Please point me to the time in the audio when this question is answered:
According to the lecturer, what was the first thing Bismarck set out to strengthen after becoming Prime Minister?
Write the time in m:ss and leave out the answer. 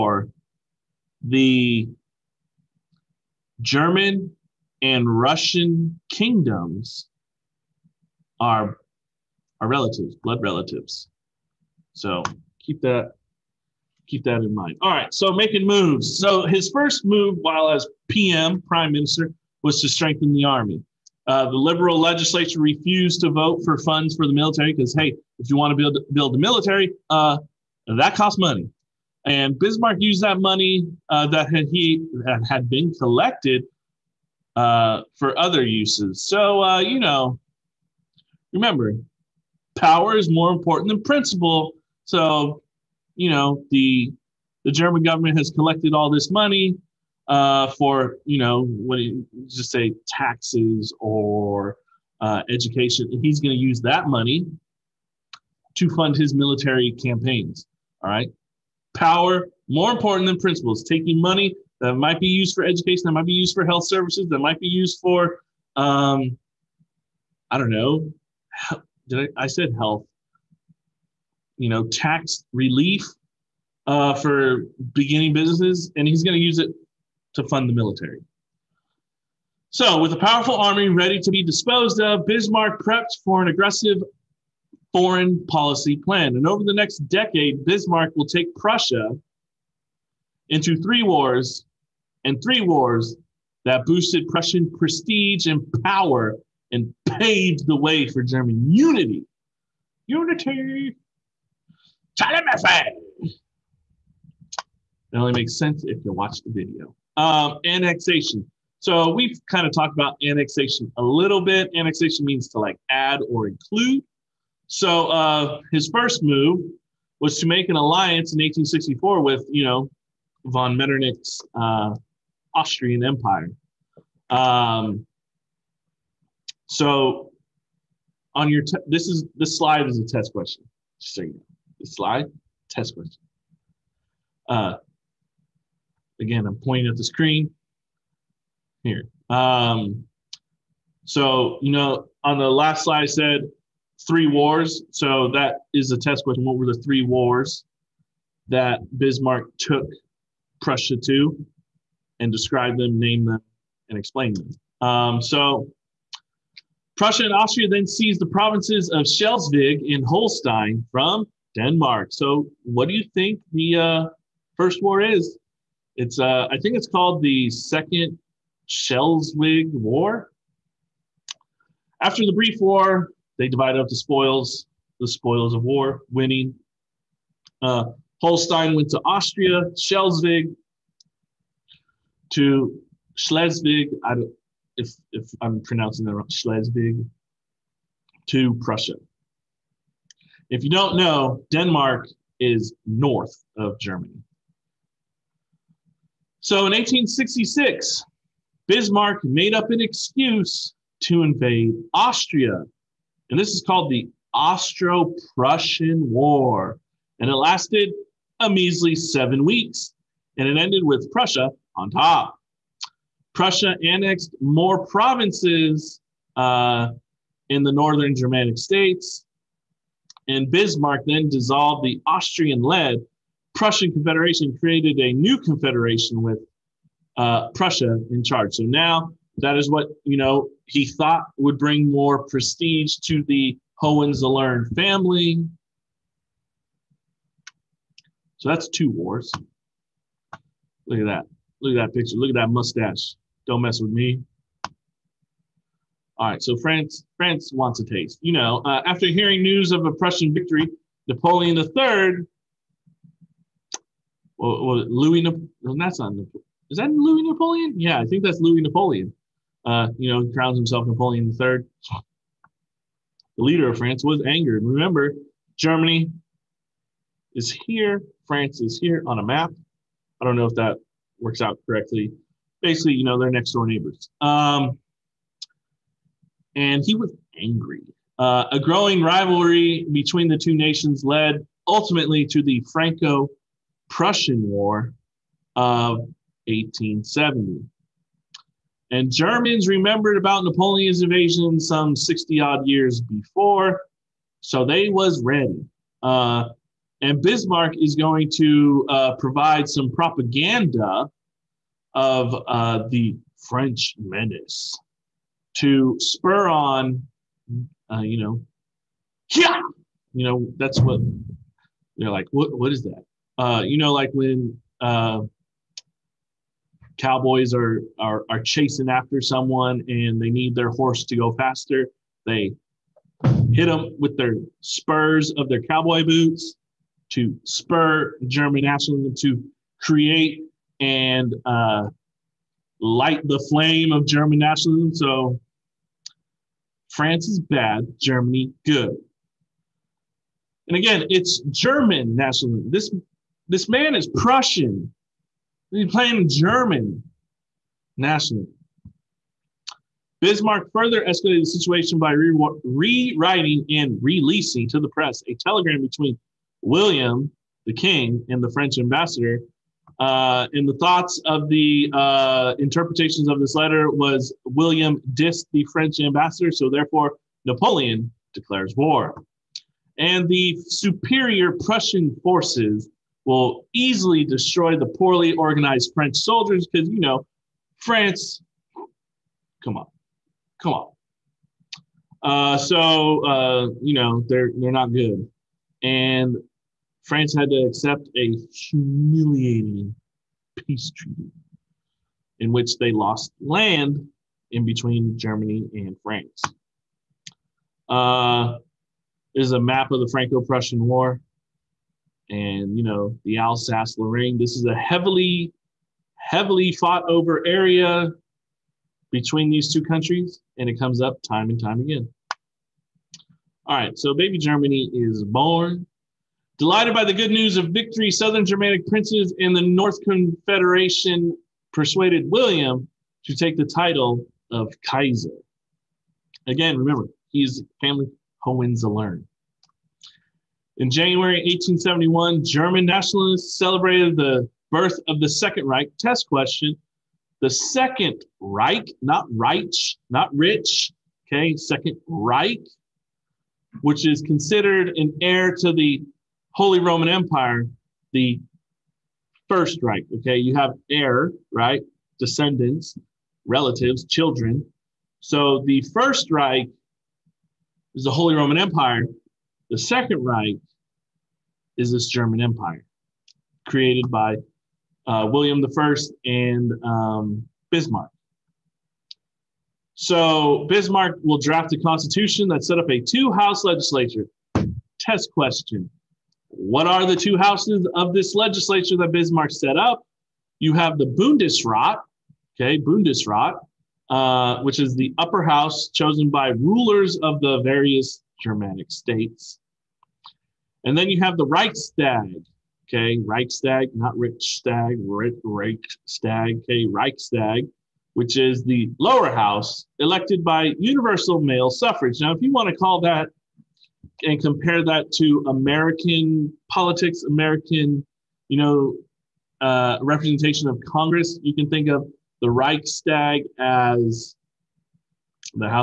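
0:19.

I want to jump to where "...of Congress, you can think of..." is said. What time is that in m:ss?
8:30.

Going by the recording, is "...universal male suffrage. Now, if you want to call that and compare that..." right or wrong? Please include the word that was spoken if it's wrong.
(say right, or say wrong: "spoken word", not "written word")
right.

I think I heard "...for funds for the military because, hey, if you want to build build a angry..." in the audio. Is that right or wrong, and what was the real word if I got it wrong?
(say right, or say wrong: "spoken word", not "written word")
wrong: "military", not "angry".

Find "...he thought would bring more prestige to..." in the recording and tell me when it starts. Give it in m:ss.
3:50.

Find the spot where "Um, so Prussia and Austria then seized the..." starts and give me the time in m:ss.
2:34.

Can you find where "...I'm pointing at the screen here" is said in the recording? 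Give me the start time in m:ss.
2:16.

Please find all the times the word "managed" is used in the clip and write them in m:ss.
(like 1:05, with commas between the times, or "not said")
not said.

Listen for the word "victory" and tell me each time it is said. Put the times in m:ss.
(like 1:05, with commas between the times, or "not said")
4:10, 6:57.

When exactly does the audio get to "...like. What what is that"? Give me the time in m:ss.
5:12.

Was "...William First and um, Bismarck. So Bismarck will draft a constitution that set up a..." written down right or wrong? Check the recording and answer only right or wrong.
right.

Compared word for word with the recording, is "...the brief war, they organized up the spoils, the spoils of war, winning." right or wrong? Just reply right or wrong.
wrong.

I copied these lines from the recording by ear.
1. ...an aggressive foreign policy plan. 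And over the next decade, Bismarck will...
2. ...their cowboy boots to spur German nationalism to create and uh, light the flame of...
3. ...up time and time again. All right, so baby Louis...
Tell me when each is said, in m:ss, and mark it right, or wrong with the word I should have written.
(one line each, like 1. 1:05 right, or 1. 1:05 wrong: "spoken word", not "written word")
1. 1:23 right
2. 5:25 right
3. 6:51 wrong: "Germany", not "Louis".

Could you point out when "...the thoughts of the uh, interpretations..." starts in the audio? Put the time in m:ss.
6:00.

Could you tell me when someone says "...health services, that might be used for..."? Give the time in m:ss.
1:03.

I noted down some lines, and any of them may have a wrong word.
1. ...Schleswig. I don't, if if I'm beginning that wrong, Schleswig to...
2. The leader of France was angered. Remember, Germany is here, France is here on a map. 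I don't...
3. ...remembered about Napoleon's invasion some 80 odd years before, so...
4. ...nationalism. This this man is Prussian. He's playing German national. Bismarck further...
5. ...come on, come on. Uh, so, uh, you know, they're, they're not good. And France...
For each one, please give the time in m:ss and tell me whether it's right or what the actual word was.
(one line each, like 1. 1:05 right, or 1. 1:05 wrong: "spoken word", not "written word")
1. 3:03 wrong: "pronouncing", not "beginning"
2. 4:23 right
3. 4:49 wrong: "60", not "80"
4. 5:42 right
5. 6:19 right.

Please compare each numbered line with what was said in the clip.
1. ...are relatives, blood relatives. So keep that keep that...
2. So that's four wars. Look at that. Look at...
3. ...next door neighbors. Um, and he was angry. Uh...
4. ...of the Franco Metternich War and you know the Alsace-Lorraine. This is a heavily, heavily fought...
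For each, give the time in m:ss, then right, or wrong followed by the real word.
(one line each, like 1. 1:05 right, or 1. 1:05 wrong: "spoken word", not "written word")
1. 0:09 right
2. 3:58 wrong: "two", not "four"
3. 4:33 right
4. 6:39 wrong: "Prussian", not "Metternich".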